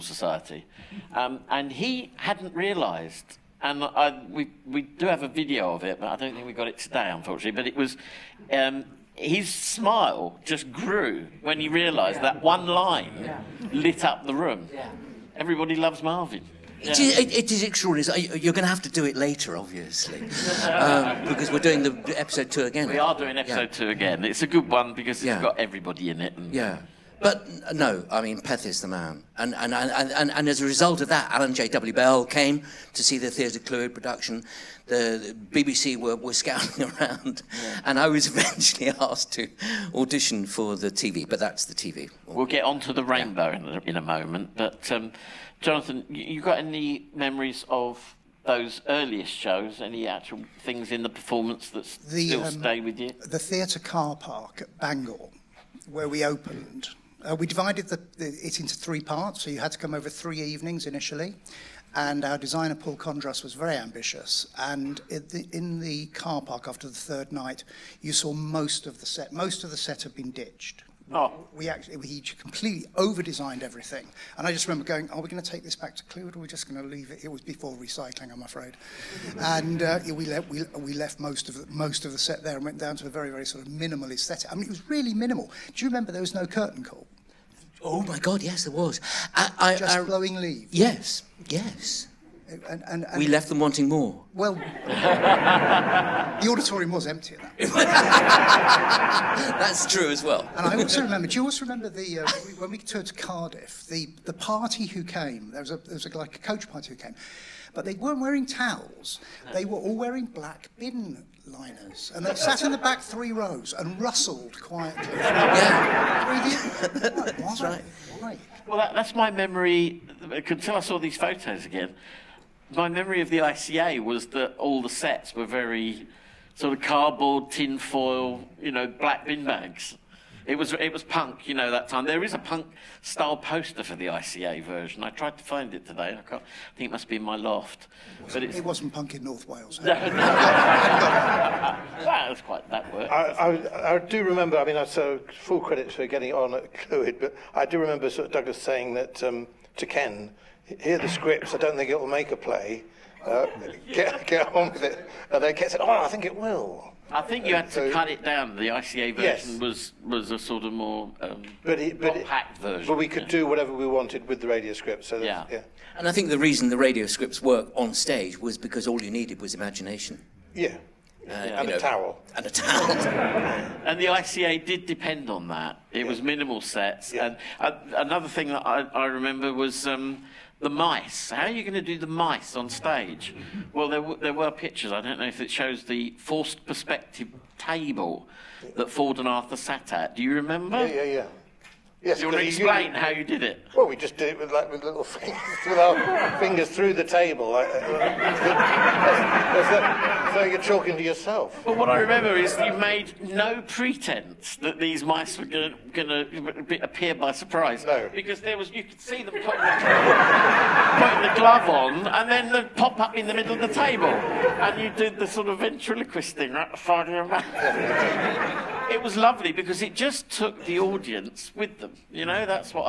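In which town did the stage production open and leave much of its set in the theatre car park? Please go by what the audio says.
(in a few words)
Bangor.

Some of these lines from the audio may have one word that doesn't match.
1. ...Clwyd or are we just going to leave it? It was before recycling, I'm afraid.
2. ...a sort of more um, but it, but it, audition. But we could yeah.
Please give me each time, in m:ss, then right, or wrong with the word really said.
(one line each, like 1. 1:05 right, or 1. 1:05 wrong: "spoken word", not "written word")
1. 1:16 right
2. 2:40 wrong: "version", not "audition".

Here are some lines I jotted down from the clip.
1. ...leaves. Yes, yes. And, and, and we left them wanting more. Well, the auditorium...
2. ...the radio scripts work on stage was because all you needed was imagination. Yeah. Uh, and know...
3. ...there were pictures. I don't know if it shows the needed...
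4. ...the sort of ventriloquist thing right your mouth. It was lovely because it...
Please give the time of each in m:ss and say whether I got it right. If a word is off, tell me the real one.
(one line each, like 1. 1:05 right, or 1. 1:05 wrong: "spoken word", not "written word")
1. 1:30 right
2. 2:46 right
3. 3:04 wrong: "forced", not "needed"
4. 3:35 right.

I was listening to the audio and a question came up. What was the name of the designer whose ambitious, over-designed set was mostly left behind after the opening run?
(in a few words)
Paul Condras.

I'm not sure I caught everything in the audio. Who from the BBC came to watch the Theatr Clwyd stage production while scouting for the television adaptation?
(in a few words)
Alan J.W. Bell.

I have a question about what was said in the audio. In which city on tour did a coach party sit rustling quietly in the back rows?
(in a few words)
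Cardiff.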